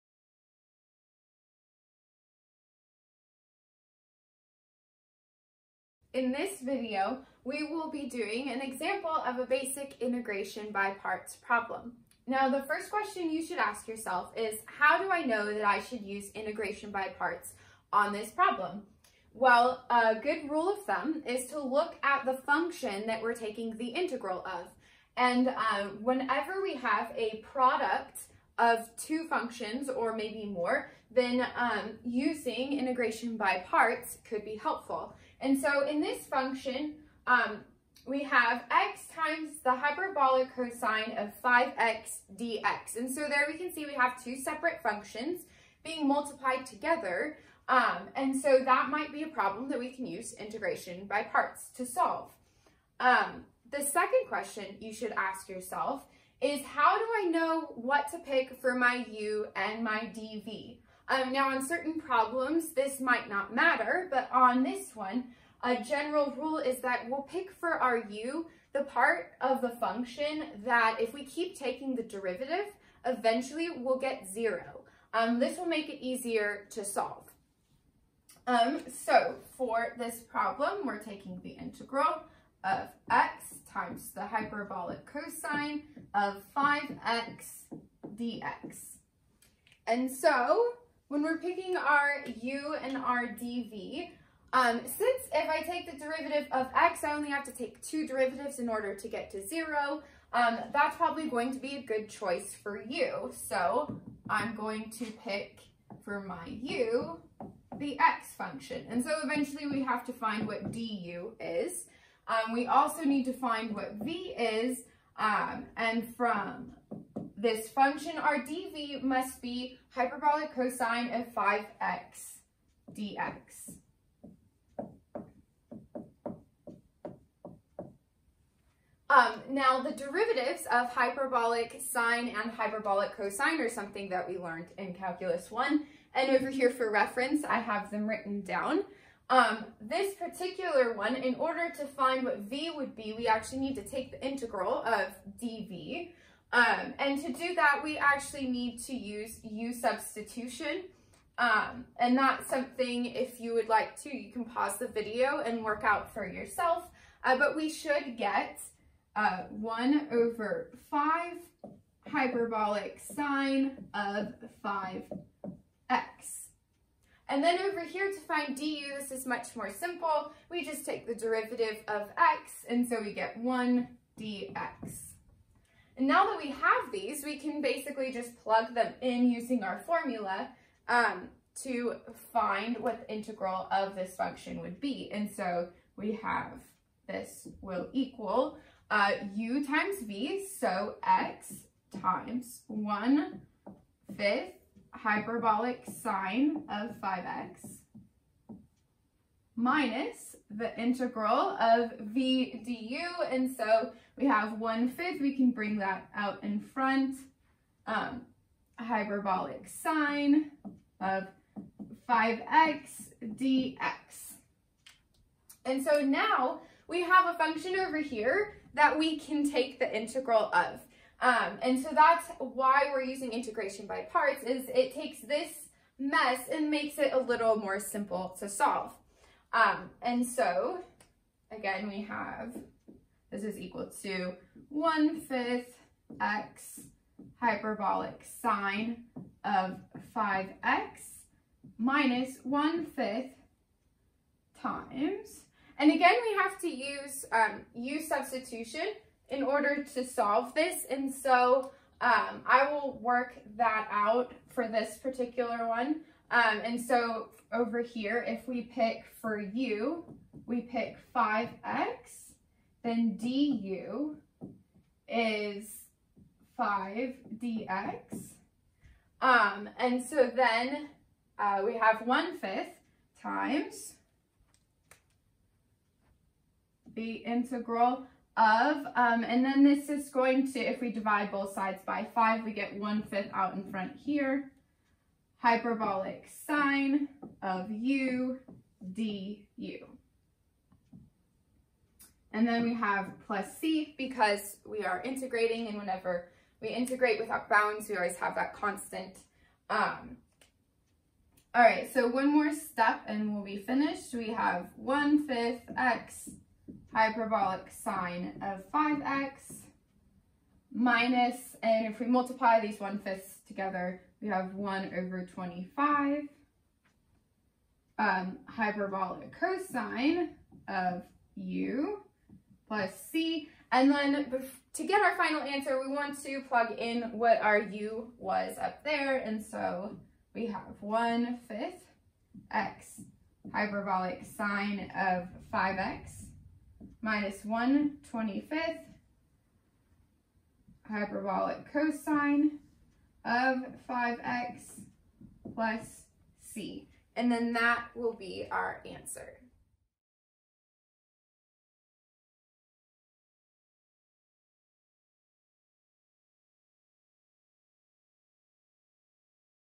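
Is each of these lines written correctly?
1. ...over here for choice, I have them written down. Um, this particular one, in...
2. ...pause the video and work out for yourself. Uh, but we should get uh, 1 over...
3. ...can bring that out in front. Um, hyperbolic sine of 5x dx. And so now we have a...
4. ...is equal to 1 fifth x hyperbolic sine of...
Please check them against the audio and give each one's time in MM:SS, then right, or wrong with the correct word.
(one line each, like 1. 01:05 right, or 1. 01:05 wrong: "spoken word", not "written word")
1. 02:16 wrong: "reference", not "choice"
2. 02:34 right
3. 03:25 right
4. 03:53 right.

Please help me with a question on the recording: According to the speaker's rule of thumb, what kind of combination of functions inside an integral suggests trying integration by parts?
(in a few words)
product of two functions.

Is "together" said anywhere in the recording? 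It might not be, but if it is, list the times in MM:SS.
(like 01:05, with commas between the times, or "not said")
00:46, 05:13.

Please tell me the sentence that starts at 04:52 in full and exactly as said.
And then we have plus c because we are integrating and whenever we integrate without bounds, we always have that constant.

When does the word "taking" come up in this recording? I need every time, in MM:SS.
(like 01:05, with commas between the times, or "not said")
00:23, 01:11, 01:21.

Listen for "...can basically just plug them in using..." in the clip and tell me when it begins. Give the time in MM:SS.
02:57.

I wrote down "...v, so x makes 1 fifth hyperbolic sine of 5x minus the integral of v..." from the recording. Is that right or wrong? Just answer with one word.
wrong.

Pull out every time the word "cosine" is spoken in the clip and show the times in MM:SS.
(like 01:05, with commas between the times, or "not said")
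00:40, 01:25, 02:00, 02:13, 05:19, 05:41.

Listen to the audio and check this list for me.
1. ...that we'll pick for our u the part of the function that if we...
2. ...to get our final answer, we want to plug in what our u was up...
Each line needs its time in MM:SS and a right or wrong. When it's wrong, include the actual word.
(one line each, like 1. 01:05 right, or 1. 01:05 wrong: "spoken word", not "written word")
1. 01:06 right
2. 05:24 right.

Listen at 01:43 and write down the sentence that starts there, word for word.
So I'm going to pick for my u, the x function.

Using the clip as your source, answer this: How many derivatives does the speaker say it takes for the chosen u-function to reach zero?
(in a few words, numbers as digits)
2.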